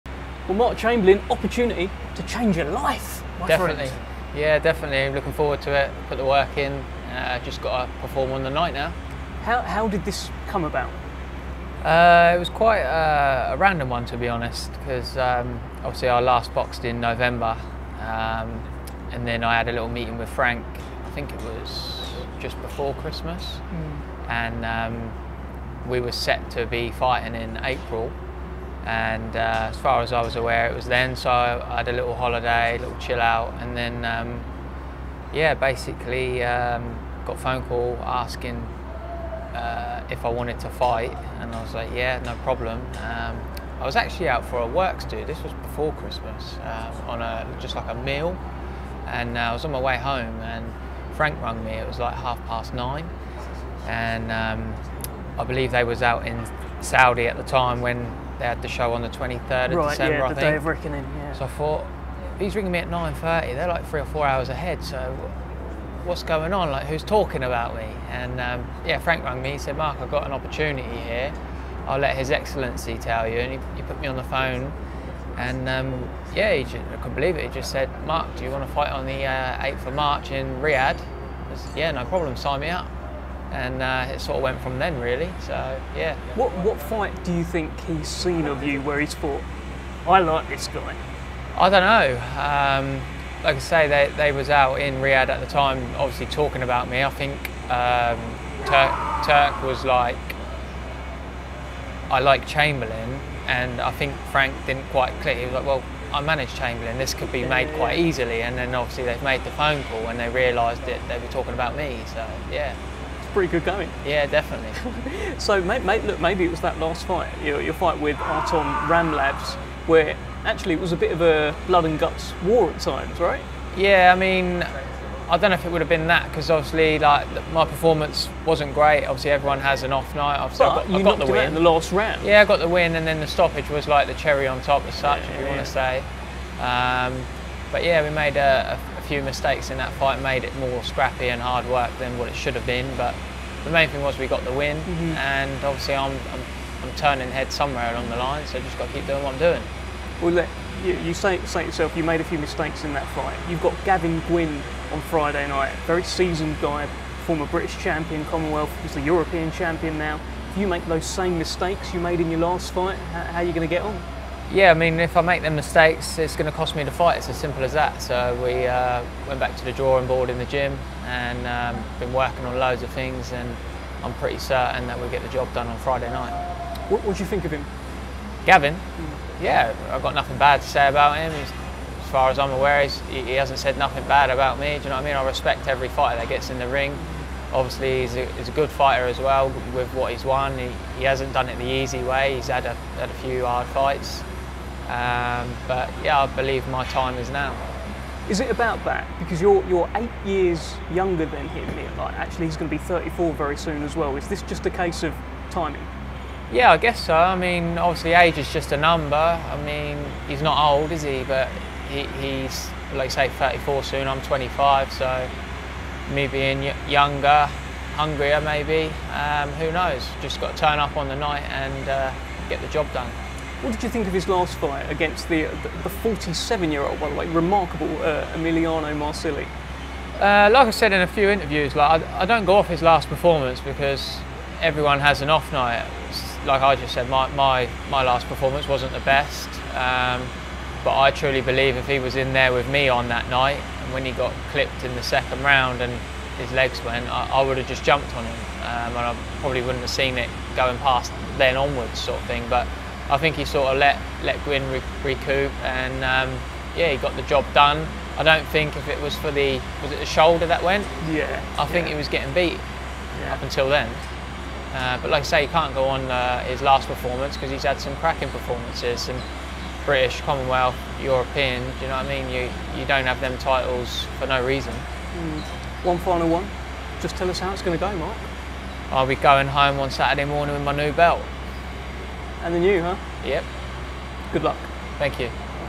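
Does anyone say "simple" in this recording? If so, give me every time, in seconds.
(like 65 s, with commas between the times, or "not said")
167 s.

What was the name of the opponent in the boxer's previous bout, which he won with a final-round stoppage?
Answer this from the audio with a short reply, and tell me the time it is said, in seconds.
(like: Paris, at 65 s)
Artom Ramlavs, at 118 s.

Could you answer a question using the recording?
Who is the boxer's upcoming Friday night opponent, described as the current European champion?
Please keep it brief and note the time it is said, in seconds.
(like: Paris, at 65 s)
Gavin Gwynne, at 153 s.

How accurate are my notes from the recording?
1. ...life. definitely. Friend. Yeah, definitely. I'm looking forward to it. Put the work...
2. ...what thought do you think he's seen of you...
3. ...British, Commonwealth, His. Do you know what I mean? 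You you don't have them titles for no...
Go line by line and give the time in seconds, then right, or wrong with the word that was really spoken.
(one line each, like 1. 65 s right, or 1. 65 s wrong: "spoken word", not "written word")
1. 2 s right
2. 86 s wrong: "fight", not "thought"
3. 269 s wrong: "European", not "His".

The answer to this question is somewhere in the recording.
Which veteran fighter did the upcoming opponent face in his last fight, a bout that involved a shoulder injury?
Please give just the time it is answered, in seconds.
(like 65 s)
228 s.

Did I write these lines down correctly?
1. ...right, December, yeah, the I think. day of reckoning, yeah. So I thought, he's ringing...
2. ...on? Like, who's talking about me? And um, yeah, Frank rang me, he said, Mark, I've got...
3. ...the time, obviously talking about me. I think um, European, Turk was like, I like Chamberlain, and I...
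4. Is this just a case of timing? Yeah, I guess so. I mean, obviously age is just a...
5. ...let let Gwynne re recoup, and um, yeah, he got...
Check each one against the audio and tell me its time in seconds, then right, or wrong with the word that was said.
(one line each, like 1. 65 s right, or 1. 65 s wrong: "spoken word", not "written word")
1. 59 s right
2. 66 s right
3. 95 s wrong: "Turk", not "European"
4. 204 s right
5. 253 s right.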